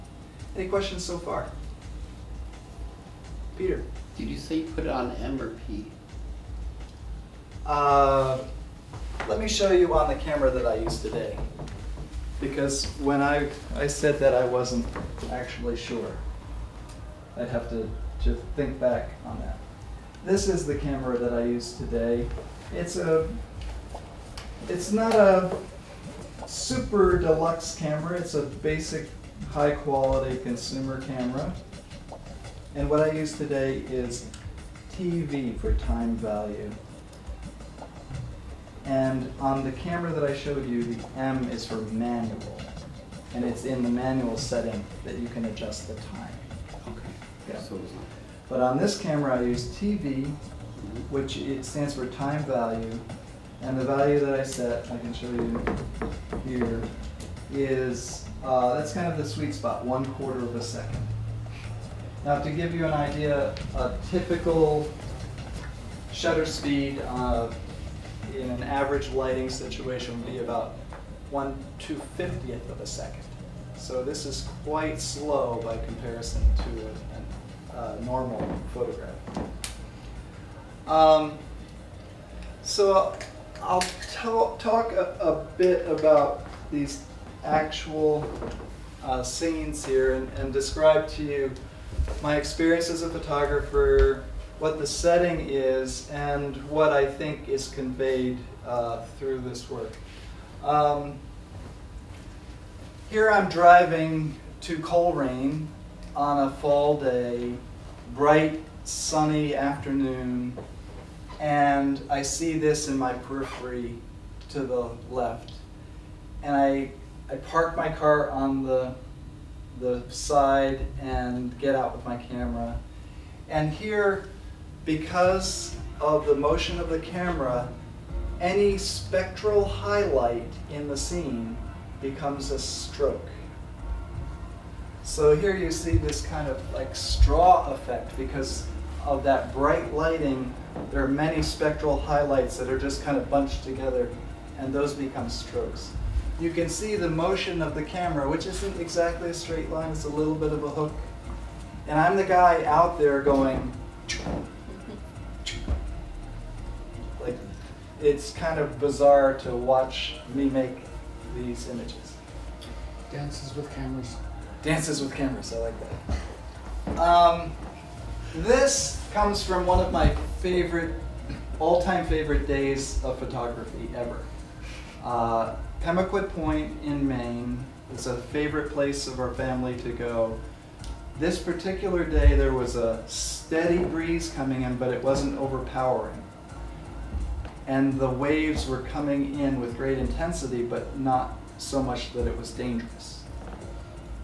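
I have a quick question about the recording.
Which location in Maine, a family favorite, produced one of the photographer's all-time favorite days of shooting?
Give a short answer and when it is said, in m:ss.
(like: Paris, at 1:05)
Pemaquid Point, at 2:55.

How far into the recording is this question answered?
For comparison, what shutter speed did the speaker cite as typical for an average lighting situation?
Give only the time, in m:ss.
1:11.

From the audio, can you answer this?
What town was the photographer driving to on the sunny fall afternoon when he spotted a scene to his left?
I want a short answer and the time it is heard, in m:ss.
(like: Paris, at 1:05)
Colrain, at 1:44.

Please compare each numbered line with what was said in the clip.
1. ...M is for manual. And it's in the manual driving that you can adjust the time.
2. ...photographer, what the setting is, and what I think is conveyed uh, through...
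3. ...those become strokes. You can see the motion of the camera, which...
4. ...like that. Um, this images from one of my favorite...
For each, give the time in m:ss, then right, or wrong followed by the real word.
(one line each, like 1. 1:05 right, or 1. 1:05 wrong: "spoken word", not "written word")
1. 0:41 wrong: "setting", not "driving"
2. 1:33 right
3. 2:24 right
4. 2:45 wrong: "comes", not "images".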